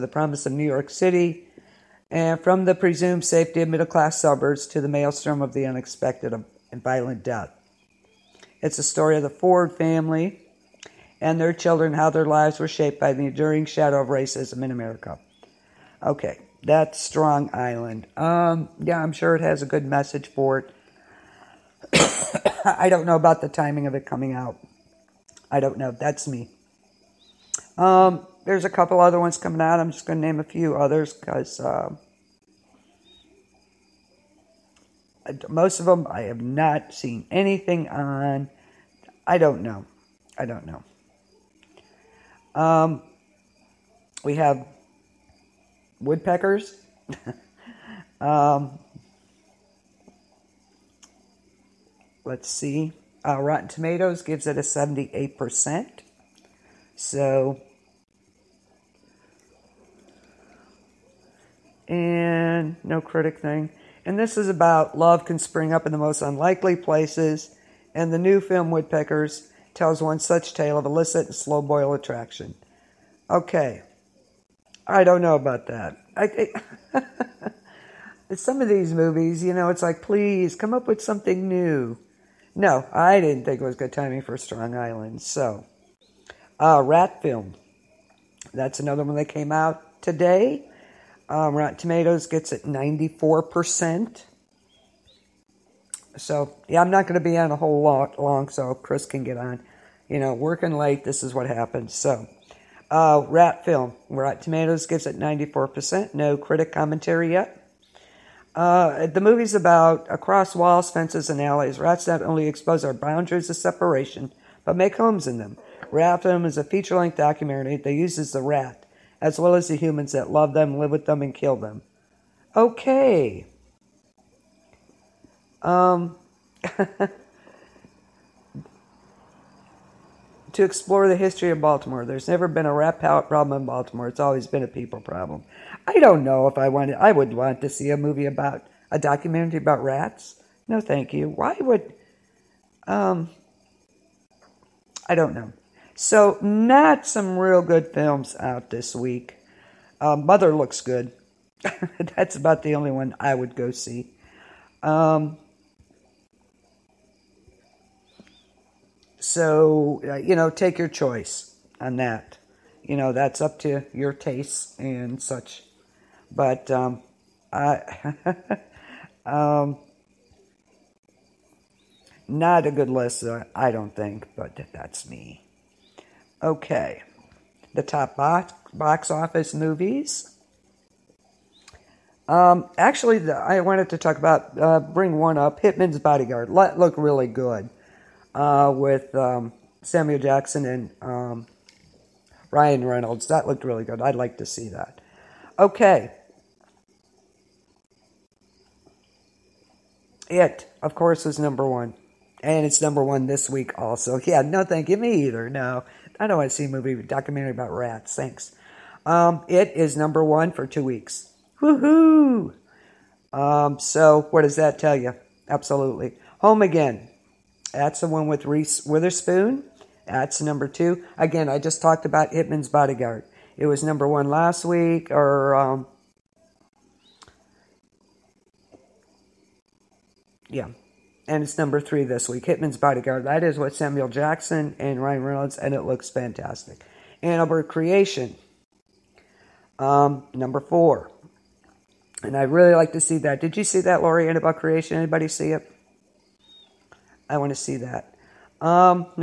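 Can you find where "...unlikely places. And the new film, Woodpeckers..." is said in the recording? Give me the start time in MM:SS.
01:06.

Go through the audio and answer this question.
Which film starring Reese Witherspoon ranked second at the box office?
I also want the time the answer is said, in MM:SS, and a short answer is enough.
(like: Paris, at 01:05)
Home Again, at 03:36.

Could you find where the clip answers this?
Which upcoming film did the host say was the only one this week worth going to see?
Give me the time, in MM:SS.
02:30.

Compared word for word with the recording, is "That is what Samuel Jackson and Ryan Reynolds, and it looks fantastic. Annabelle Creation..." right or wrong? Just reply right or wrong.
right.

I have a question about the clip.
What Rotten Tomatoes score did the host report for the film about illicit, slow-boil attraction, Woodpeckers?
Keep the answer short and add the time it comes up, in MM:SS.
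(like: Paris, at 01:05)
78%, at 00:54.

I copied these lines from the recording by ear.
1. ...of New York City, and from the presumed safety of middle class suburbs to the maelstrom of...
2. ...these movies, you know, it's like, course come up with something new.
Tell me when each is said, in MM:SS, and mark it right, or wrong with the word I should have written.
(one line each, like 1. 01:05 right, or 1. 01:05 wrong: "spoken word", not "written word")
1. 00:00 right
2. 01:18 wrong: "please", not "course".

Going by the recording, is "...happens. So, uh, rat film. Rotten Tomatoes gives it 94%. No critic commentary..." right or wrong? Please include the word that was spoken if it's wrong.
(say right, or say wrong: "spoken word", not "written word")
right.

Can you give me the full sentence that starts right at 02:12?
There's never been a rap problem in Baltimore.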